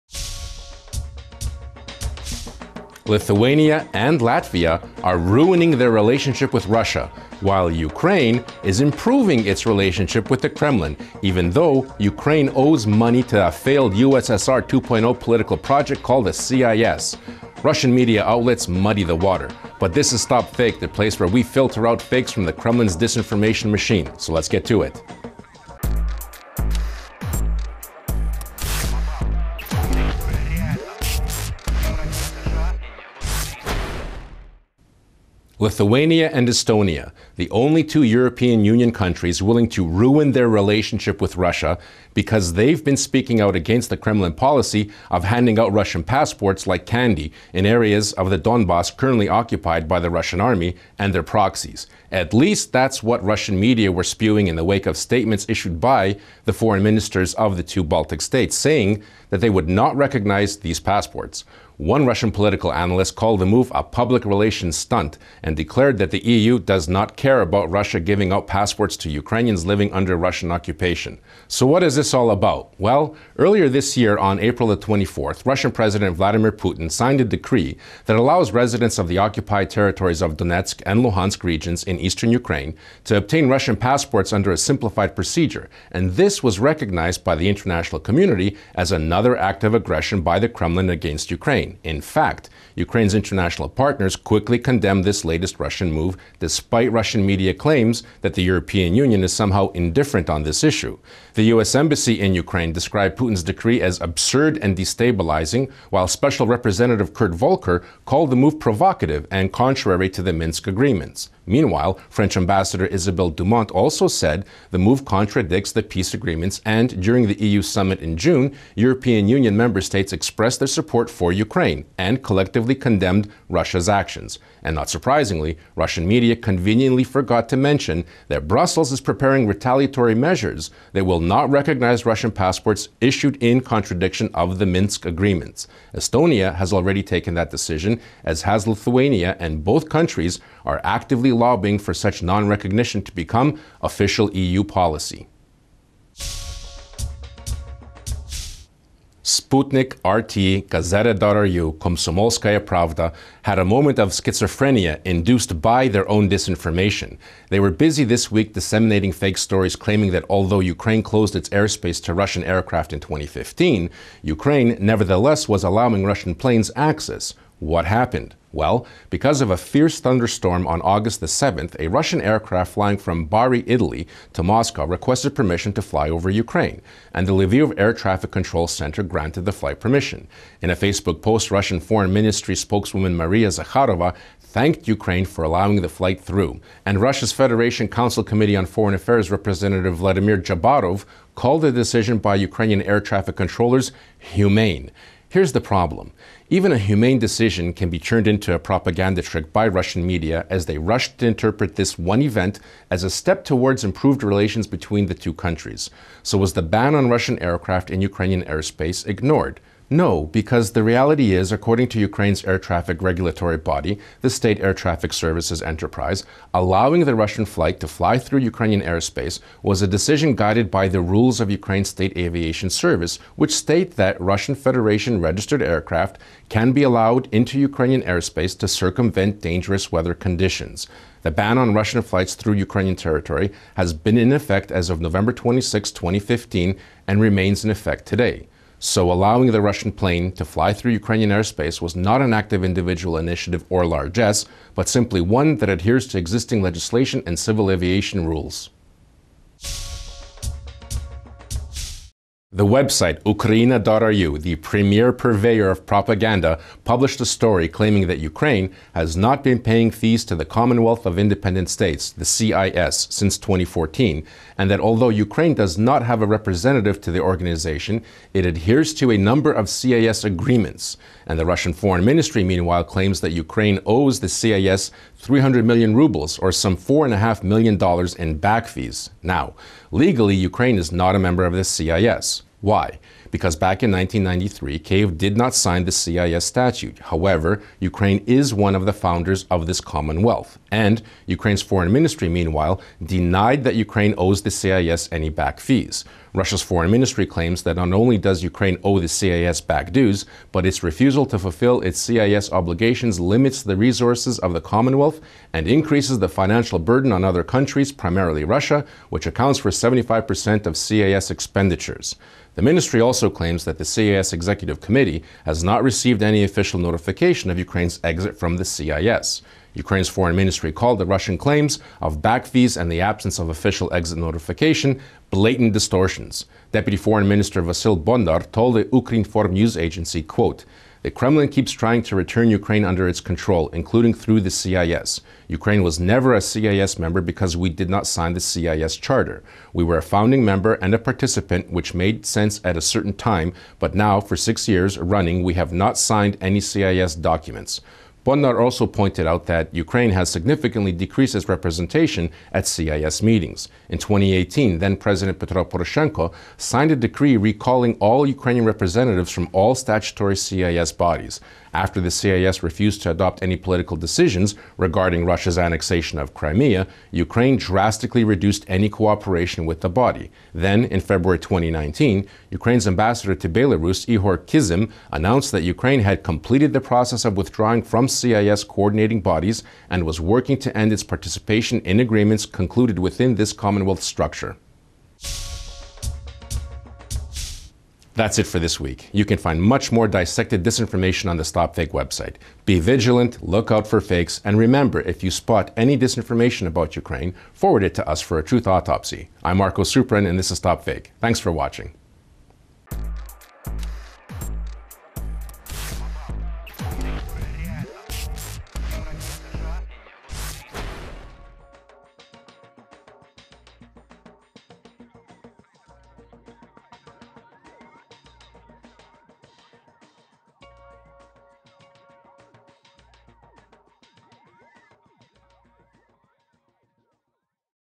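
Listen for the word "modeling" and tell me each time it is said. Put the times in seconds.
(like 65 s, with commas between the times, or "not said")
not said.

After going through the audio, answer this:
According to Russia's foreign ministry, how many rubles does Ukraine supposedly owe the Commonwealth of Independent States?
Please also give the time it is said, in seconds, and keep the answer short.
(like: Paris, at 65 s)
300 million rubles, at 275 s.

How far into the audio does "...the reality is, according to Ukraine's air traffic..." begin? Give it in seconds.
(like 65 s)
210 s.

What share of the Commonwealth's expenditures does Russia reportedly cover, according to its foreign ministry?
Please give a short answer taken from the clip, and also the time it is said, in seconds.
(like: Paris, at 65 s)
75%, at 309 s.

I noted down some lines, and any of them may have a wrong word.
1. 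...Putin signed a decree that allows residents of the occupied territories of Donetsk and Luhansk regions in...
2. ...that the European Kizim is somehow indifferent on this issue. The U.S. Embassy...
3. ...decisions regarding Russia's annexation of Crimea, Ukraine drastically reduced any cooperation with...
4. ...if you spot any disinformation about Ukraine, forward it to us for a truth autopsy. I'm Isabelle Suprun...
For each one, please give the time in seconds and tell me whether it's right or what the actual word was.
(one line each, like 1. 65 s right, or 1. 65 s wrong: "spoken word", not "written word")
1. 76 s right
2. 98 s wrong: "Union", not "Kizim"
3. 363 s right
4. 395 s wrong: "Marko", not "Isabelle".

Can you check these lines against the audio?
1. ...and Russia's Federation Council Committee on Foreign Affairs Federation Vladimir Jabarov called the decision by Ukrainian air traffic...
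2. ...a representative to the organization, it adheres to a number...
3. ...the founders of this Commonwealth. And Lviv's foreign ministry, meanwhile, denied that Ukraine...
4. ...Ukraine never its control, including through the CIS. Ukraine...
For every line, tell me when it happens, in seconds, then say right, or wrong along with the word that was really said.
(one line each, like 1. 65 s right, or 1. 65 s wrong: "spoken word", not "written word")
1. 186 s wrong: "Representative", not "Federation"
2. 266 s right
3. 288 s wrong: "Ukraine", not "Lviv"
4. 332 s wrong: "under", not "never".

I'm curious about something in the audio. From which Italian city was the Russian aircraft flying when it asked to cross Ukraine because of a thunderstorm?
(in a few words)
Bari.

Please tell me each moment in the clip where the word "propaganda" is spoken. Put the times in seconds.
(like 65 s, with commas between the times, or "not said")
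198 s, 255 s.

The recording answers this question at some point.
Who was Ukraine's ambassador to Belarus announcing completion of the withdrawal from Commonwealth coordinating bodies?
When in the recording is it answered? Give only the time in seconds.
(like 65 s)
374 s.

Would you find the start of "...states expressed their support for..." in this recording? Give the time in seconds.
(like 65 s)
119 s.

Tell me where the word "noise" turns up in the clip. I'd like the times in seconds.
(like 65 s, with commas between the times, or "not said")
not said.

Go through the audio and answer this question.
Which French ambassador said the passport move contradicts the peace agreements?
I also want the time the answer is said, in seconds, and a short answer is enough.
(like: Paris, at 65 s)
Isabelle Dumont, at 112 s.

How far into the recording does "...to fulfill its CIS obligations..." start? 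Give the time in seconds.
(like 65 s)
301 s.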